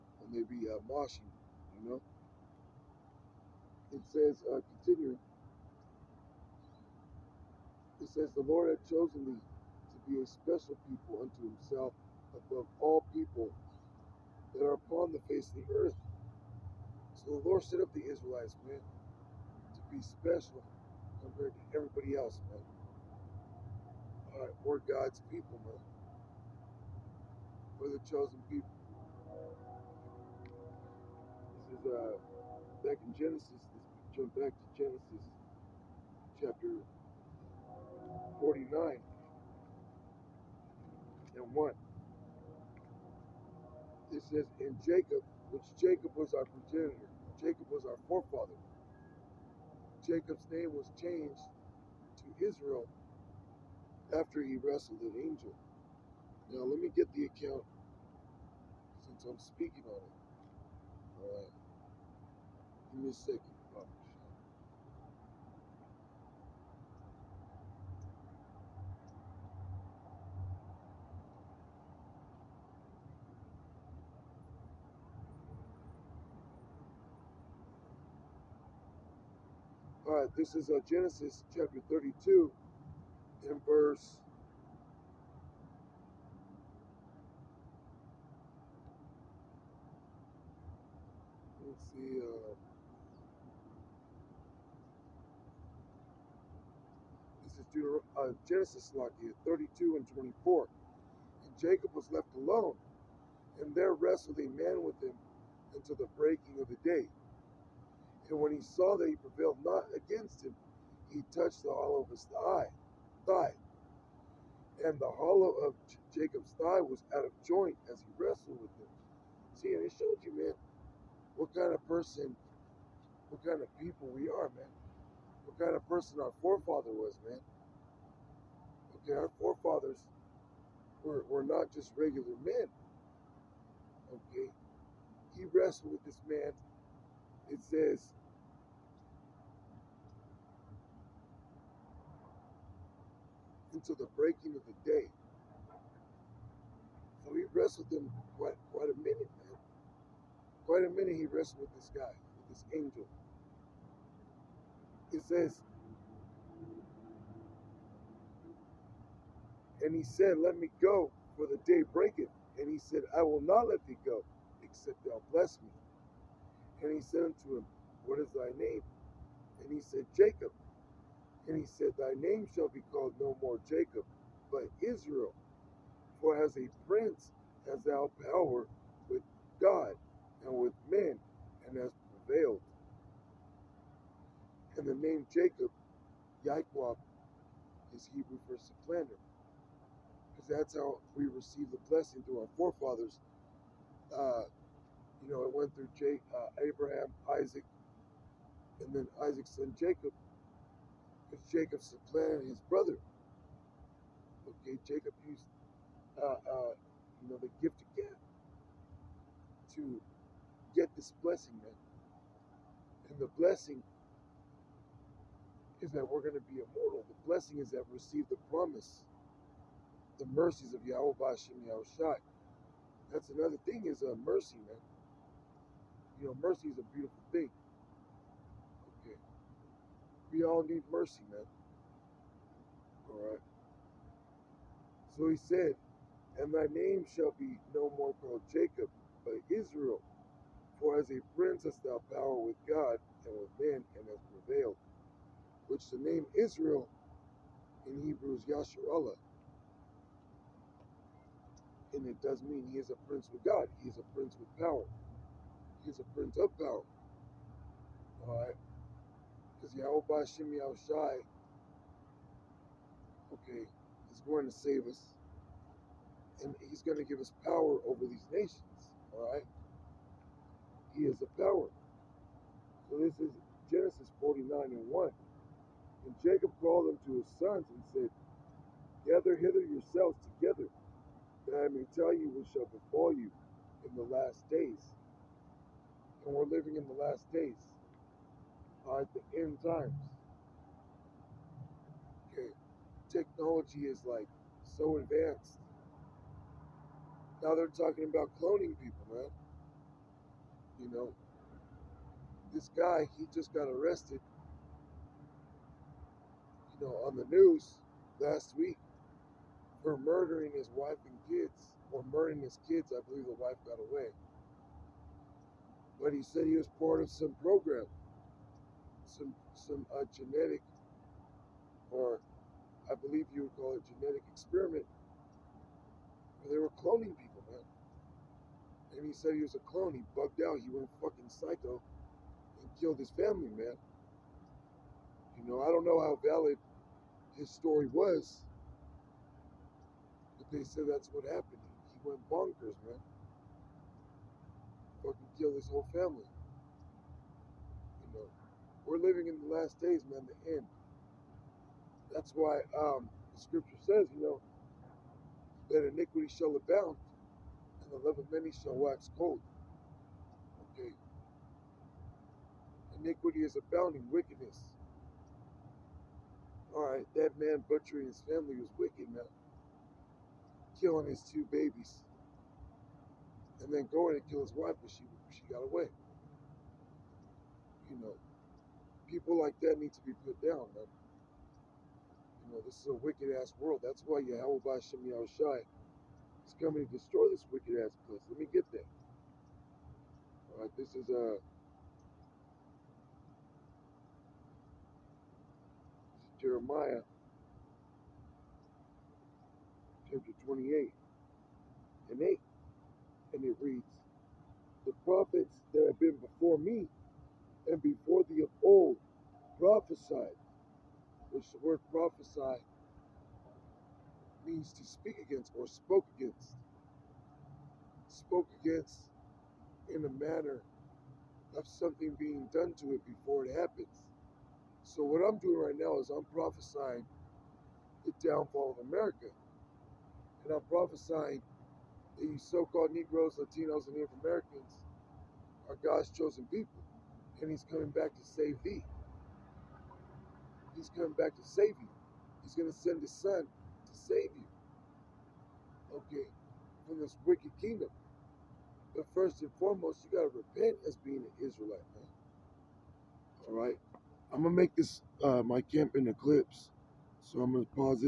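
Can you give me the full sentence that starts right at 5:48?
You know, we're living in the last days, man, the end.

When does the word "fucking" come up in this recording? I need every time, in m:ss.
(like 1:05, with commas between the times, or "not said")
5:30, 5:45.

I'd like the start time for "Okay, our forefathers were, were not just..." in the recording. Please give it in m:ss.
2:09.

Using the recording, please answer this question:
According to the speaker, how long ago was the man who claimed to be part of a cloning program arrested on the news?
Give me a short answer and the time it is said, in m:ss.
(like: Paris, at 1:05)
Last week, at 5:08.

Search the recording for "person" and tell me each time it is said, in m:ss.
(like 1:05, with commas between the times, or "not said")
2:01, 2:05.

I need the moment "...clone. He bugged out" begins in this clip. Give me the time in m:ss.
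5:29.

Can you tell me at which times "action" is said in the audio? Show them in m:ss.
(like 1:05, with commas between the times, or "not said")
not said.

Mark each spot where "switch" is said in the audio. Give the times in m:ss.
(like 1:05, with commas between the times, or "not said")
not said.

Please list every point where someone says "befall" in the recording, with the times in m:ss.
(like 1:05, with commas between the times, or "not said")
4:42.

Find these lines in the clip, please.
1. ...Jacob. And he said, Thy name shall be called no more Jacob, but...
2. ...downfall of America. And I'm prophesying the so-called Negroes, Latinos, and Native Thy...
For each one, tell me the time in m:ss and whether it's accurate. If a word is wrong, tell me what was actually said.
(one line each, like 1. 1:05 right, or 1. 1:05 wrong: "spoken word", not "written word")
1. 2:50 right
2. 7:08 wrong: "Americans", not "Thy".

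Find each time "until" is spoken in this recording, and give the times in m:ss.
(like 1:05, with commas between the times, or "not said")
1:45, 2:23.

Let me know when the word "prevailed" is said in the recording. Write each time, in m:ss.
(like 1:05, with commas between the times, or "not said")
1:49, 3:02, 4:04.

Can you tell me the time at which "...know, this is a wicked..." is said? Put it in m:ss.
6:22.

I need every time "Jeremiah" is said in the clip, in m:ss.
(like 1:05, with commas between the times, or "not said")
6:36.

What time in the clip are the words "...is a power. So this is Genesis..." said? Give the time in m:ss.
4:31.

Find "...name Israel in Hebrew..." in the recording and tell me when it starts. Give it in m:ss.
4:05.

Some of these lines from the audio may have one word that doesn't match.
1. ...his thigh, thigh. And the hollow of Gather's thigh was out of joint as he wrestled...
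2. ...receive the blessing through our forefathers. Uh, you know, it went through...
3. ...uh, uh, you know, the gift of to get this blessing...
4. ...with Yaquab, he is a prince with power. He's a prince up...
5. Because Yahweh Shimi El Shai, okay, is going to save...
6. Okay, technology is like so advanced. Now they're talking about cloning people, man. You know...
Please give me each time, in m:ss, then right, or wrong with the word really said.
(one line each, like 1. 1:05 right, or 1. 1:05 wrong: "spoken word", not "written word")
1. 1:52 wrong: "Jacob", not "Gather"
2. 3:11 right
3. 3:26 right
4. 4:13 wrong: "God", not "Yaquab"
5. 4:19 right
6. 4:52 right.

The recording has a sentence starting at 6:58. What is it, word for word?
Spoke against in a manner of something being done to it before it happens.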